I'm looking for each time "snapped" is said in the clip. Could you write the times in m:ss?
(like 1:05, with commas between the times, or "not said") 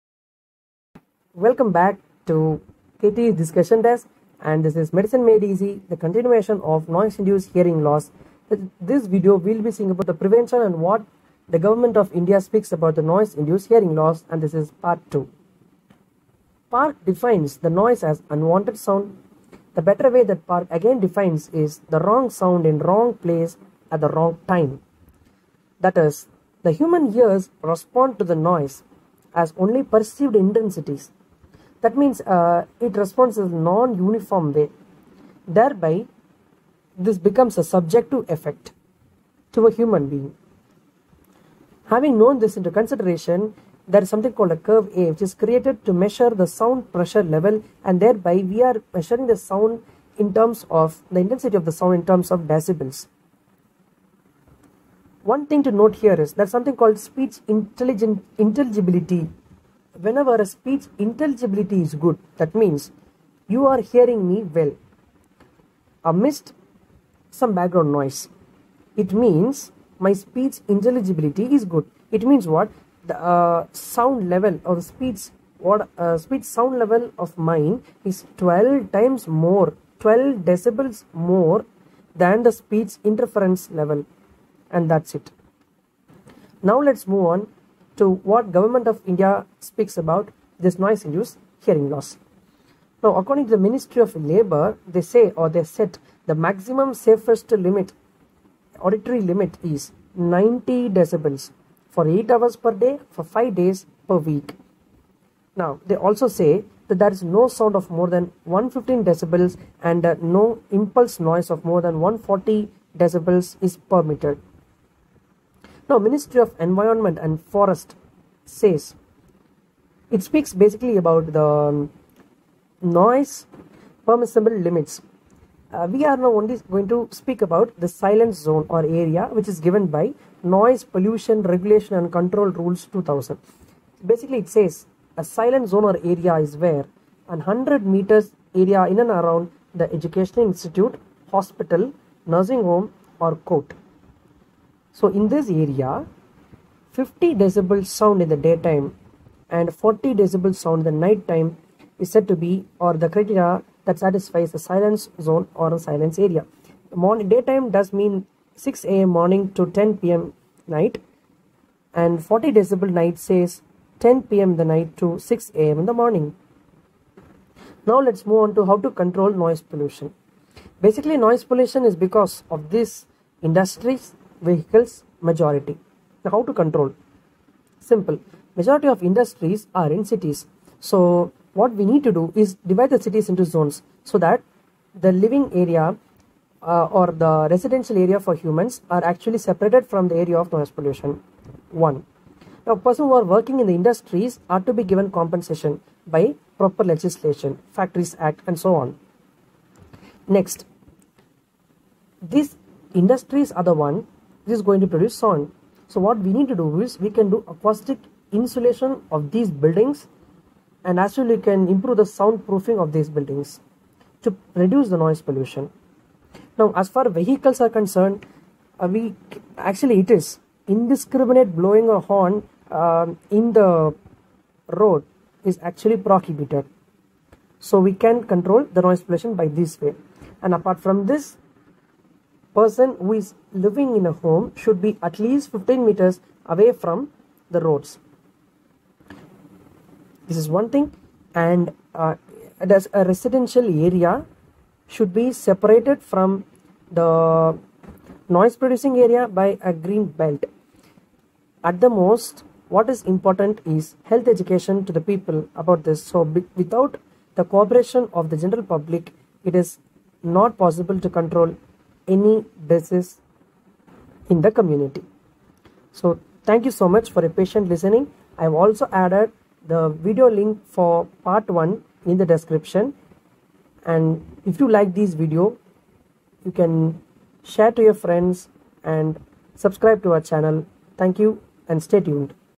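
not said.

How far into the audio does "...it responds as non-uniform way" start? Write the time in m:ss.
0:32.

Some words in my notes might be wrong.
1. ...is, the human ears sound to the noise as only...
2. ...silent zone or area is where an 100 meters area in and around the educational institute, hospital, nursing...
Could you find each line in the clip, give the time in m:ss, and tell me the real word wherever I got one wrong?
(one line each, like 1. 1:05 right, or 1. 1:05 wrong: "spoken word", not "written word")
1. 0:25 wrong: "respond", not "sound"
2. 2:15 right.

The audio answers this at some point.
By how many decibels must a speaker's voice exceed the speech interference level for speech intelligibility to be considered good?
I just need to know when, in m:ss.
1:19.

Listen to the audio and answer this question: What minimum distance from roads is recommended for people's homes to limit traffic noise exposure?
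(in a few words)
15 meters.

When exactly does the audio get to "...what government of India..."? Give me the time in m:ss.
1:28.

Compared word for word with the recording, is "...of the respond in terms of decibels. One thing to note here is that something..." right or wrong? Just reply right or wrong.
wrong.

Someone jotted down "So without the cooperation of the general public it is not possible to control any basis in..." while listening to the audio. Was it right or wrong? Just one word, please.
right.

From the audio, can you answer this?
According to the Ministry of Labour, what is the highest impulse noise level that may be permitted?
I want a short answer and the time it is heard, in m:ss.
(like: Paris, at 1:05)
140 decibels, at 1:52.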